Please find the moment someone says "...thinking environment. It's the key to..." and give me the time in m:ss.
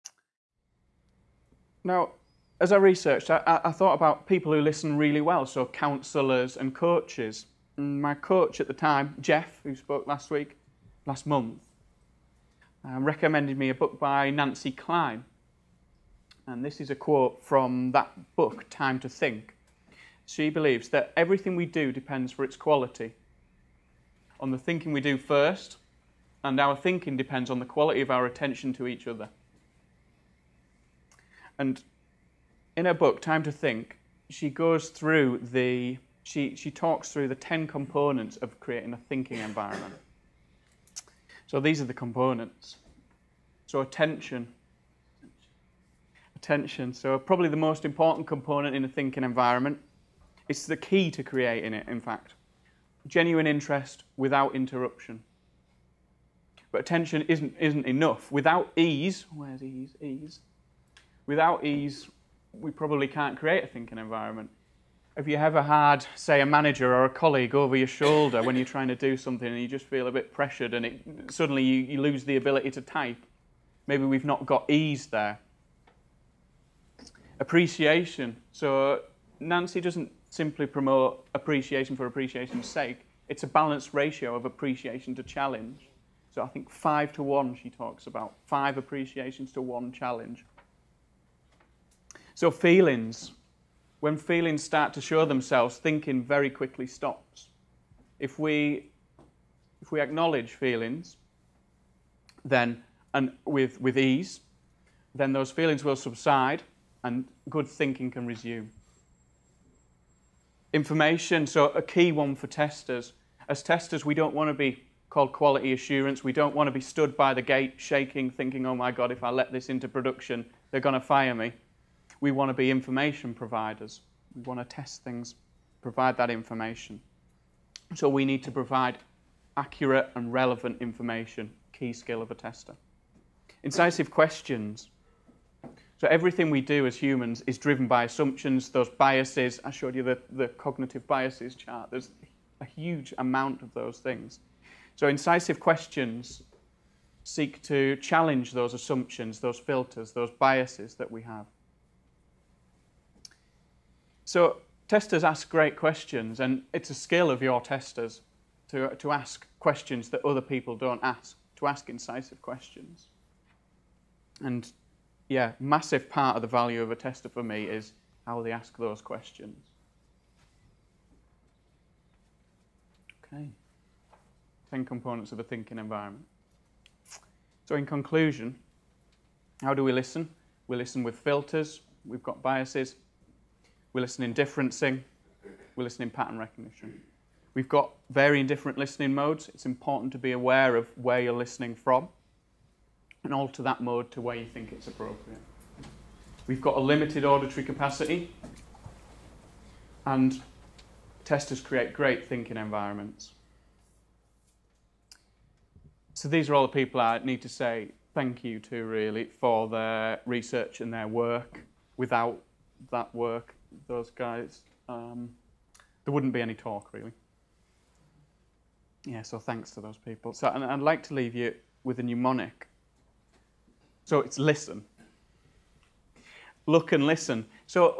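0:48.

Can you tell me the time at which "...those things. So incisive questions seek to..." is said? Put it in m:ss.
2:23.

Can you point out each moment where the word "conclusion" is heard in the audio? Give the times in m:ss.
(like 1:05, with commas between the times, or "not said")
2:57.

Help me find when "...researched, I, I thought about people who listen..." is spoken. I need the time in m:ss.
0:02.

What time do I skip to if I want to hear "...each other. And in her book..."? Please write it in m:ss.
0:28.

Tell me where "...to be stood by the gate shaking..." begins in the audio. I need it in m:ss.
1:56.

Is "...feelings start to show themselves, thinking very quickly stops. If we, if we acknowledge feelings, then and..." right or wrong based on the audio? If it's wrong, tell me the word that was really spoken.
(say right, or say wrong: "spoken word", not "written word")
right.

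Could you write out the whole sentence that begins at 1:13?
Maybe we've not got ease there.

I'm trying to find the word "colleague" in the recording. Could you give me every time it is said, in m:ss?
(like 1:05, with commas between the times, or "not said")
1:07.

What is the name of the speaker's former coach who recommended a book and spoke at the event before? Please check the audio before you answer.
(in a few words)
Jeff.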